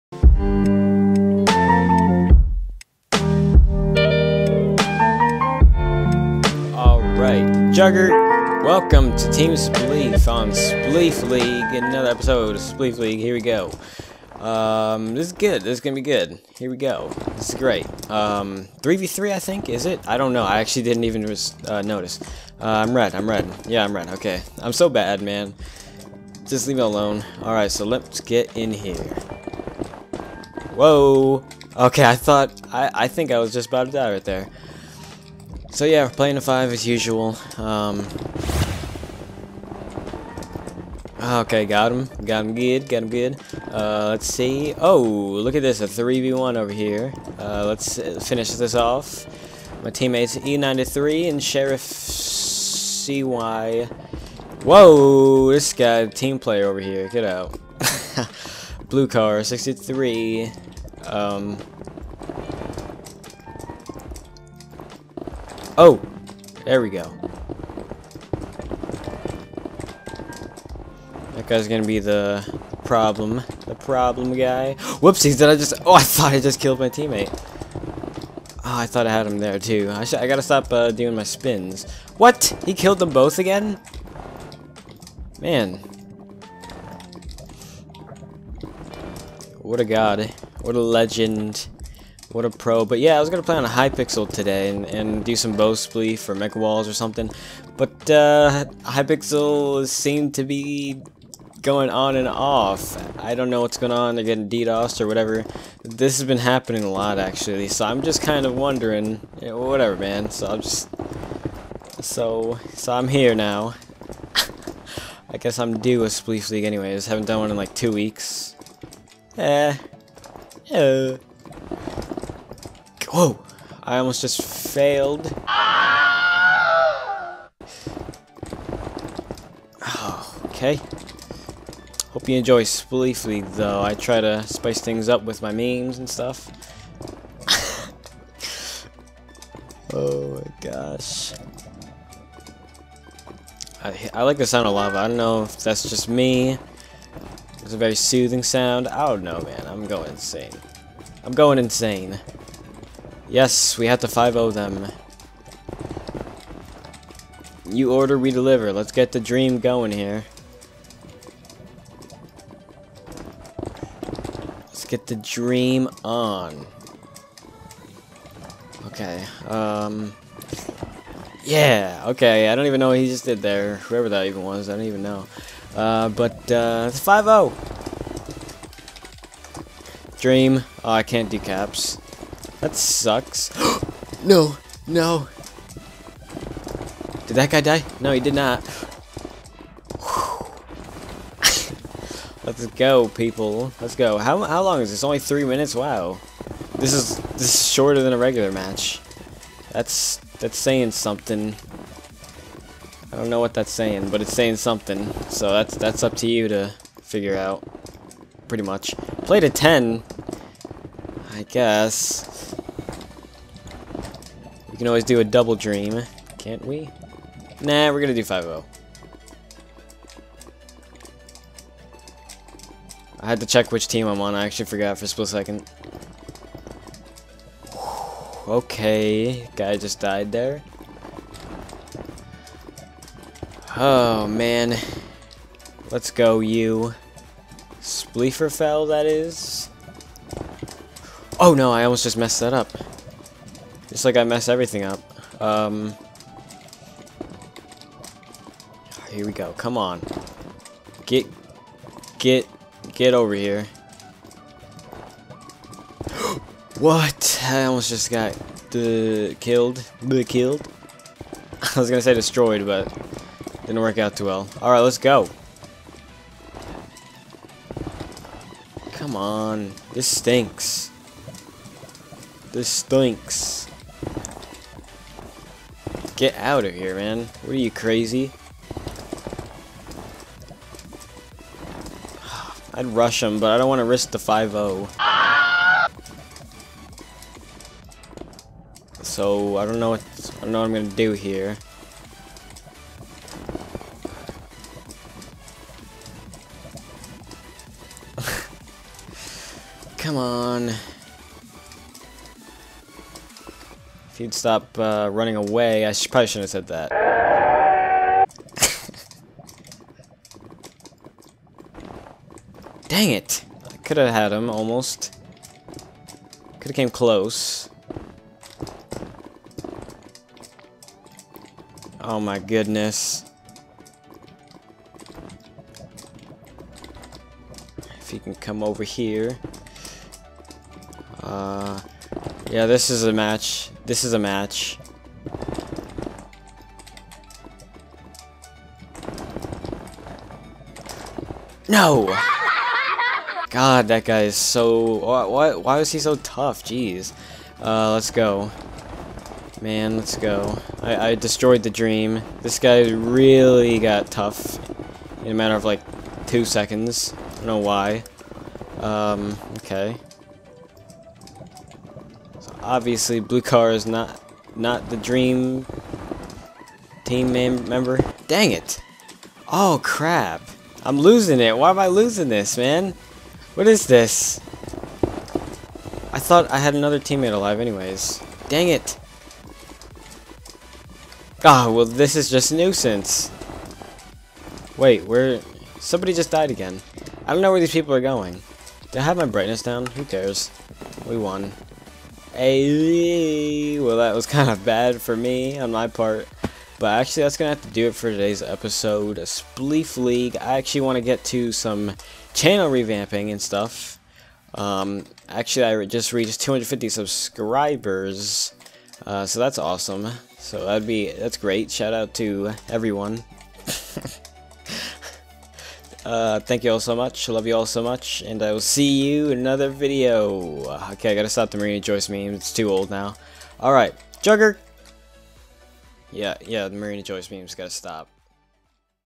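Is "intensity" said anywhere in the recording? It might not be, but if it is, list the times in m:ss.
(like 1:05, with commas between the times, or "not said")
not said.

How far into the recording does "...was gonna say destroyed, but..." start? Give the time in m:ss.
4:21.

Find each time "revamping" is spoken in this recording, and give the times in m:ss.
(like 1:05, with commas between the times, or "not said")
6:42.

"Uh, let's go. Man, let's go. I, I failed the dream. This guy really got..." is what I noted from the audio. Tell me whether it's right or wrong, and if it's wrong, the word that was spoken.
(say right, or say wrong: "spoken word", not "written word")
wrong: "destroyed", not "failed".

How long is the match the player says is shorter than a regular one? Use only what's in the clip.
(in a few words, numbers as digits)
three minutes.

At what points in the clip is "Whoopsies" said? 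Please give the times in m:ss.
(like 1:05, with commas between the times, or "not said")
1:15.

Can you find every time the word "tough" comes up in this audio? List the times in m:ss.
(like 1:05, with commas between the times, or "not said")
5:46, 5:54.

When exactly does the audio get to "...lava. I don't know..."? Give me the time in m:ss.
2:24.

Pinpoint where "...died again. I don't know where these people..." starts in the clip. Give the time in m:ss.
6:26.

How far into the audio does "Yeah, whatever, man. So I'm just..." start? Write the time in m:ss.
1:49.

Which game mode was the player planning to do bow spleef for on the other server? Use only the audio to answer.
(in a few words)
Mega Walls.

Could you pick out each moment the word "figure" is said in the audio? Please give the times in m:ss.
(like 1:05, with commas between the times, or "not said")
3:27.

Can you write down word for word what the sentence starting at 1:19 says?
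I, I gotta stop uh, doing my spins.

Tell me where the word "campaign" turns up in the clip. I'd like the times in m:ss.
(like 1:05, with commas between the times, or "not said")
not said.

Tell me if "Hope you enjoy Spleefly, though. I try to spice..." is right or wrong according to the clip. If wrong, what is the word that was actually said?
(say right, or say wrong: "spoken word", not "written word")
right.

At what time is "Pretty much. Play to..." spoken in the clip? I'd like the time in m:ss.
3:28.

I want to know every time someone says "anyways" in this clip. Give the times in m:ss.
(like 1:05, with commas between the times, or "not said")
1:56, 6:17.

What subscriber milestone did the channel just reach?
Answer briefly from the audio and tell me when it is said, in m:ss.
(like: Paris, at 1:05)
250, at 6:46.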